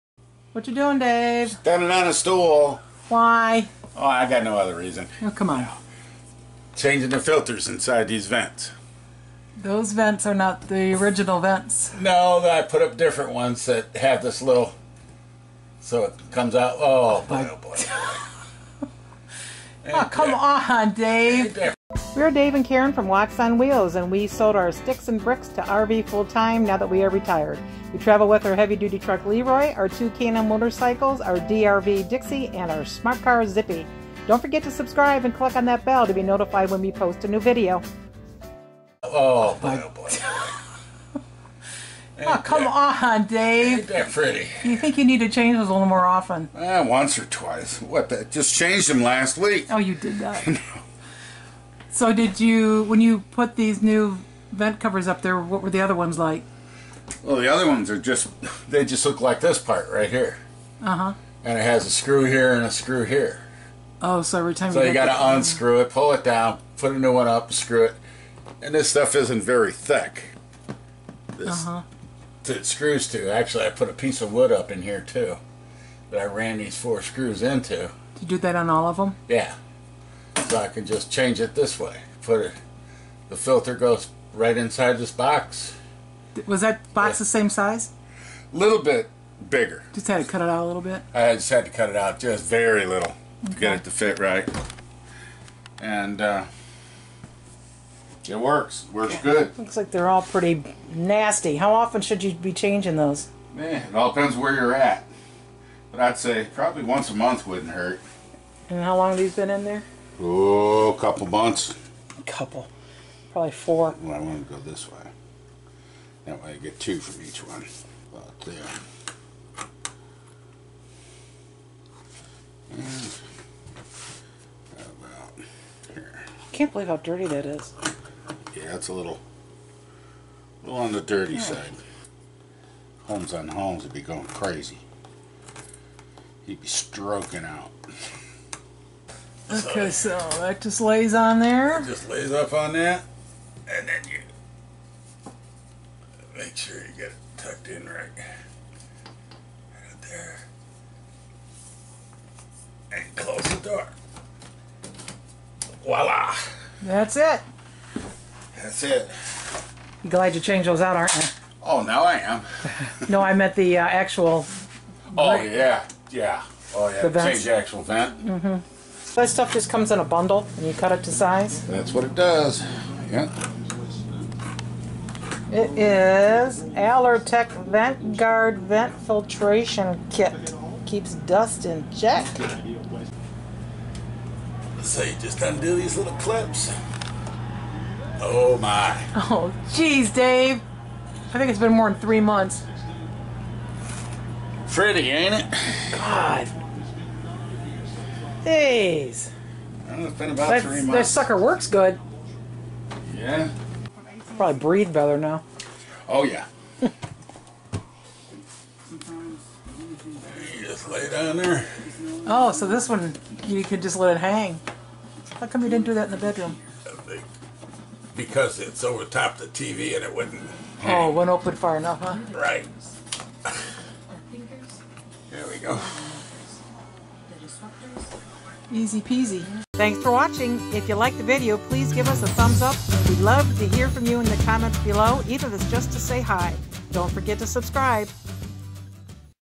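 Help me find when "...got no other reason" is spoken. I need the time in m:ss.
0:04.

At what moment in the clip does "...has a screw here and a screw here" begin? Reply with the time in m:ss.
1:01.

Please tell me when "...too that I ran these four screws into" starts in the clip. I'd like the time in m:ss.
1:15.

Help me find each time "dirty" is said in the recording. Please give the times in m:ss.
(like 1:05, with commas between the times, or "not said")
2:06, 2:11.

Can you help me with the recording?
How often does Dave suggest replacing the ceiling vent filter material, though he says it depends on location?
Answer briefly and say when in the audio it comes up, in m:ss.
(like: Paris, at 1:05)
Once a month, at 1:46.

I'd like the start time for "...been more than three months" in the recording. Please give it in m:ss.
3:11.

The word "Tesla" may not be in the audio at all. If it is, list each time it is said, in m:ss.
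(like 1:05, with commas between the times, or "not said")
not said.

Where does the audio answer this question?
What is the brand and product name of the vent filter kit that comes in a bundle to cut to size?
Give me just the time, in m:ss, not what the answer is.
2:56.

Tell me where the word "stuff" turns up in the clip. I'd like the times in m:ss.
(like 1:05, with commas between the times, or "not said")
1:08, 2:49.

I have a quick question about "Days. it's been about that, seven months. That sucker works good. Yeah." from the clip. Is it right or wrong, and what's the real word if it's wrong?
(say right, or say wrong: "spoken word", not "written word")
wrong: "three", not "seven".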